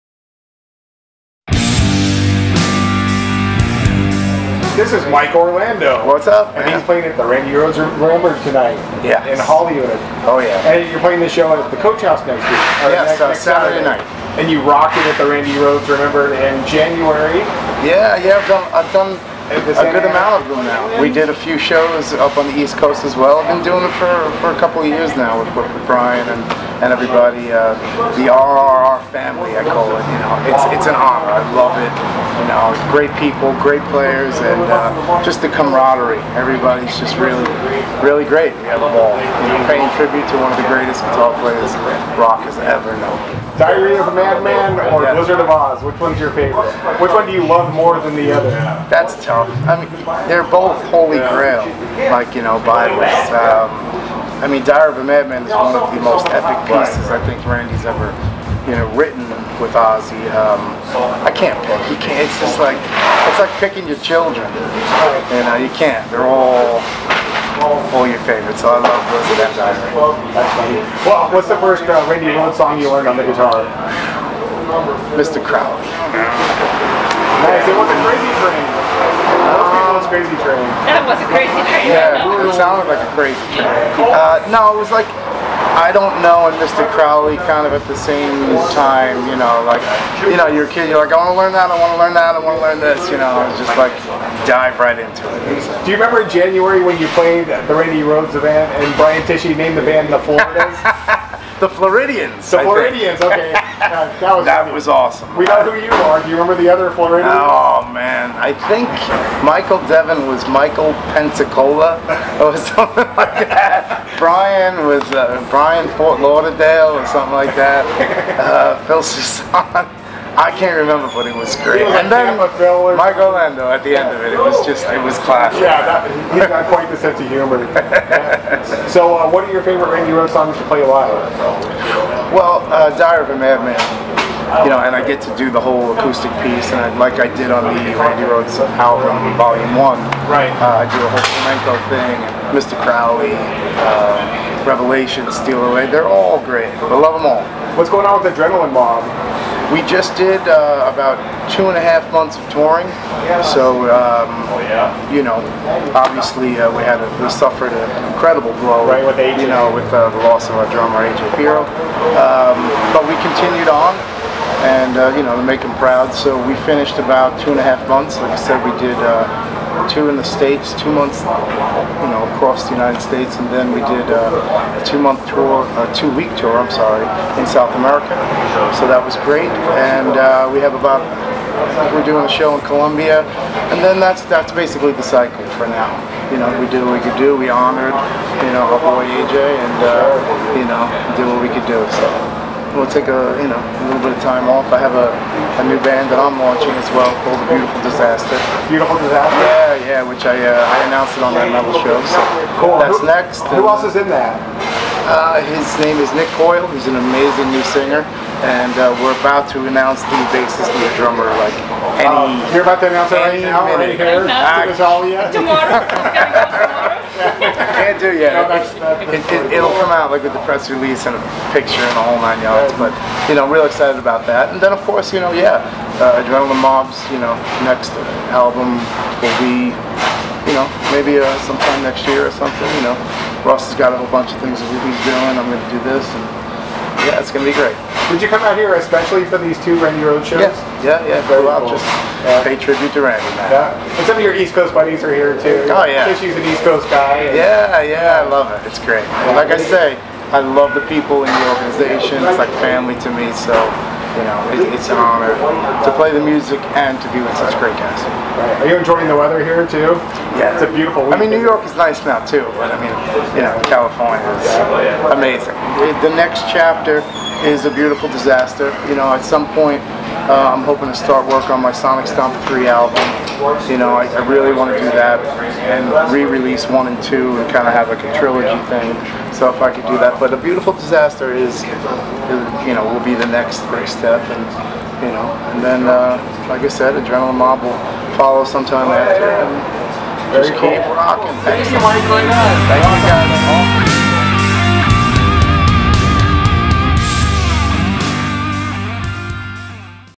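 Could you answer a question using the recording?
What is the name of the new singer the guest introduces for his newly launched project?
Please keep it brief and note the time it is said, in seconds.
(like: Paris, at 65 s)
Nick Coyle, at 206 s.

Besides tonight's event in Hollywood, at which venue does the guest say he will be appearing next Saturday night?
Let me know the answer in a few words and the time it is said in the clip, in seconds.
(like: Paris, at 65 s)
Coach House, at 11 s.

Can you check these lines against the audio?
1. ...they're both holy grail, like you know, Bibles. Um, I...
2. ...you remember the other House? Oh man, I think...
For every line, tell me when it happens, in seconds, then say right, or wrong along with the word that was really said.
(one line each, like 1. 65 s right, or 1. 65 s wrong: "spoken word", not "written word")
1. 50 s right
2. 106 s wrong: "Floridians", not "House".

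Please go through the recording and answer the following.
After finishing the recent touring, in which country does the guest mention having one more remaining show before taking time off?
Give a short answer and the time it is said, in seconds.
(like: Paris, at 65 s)
Colombia, at 182 s.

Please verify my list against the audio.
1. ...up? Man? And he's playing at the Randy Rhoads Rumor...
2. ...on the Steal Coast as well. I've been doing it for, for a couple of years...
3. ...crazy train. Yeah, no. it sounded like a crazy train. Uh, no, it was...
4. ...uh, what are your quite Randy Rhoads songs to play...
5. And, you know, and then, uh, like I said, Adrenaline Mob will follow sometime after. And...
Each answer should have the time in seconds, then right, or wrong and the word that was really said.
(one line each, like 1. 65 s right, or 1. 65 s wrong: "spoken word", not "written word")
1. 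6 s right
2. 22 s wrong: "East", not "Steal"
3. 81 s right
4. 129 s wrong: "favorite", not "quite"
5. 284 s right.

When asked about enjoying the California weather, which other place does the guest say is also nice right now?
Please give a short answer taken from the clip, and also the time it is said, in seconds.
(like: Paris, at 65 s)
New York, at 261 s.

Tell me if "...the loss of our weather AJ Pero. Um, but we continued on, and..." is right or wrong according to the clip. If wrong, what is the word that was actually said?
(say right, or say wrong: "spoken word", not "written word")
wrong: "drummer", not "weather".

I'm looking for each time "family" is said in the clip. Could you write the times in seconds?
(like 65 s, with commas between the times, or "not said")
29 s, 252 s.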